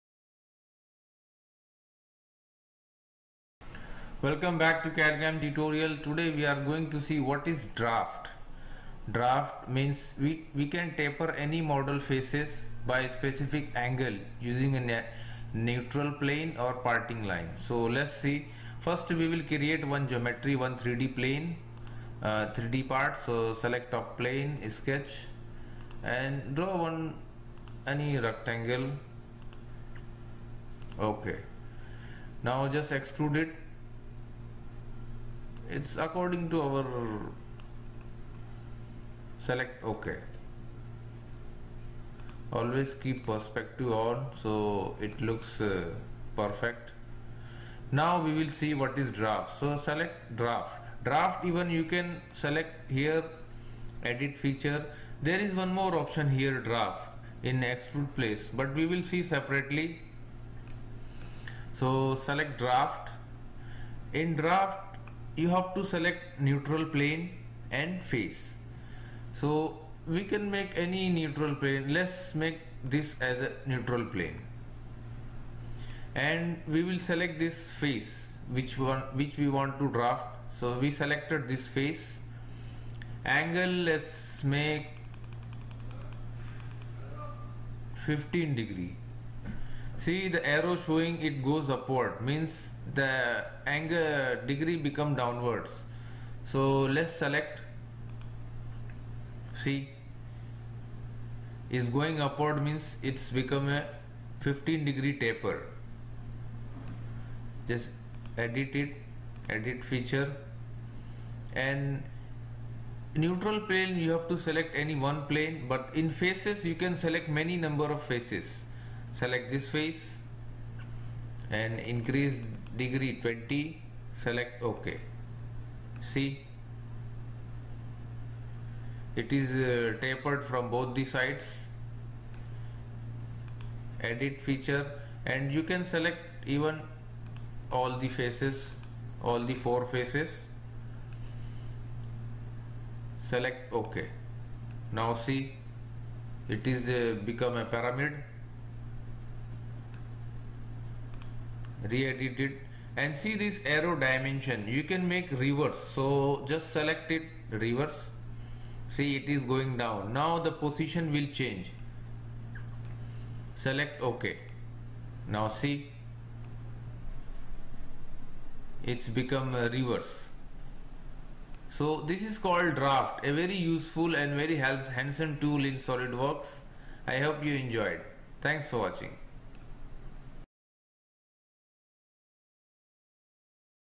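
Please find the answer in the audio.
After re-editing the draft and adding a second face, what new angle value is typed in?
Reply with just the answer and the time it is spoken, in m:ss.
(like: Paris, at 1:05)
20, at 2:03.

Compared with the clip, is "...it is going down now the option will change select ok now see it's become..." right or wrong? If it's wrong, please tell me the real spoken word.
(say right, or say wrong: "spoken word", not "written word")
wrong: "position", not "option".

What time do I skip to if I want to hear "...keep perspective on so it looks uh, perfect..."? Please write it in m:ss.
0:43.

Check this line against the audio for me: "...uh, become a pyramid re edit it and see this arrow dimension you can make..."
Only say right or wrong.
right.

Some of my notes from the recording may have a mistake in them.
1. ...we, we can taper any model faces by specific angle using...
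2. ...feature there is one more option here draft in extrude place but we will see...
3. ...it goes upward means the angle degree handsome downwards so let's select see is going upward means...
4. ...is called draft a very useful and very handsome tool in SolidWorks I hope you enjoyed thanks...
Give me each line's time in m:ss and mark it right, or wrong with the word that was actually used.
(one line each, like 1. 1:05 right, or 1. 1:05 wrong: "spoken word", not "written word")
1. 0:10 right
2. 0:54 right
3. 1:31 wrong: "become", not "handsome"
4. 2:52 right.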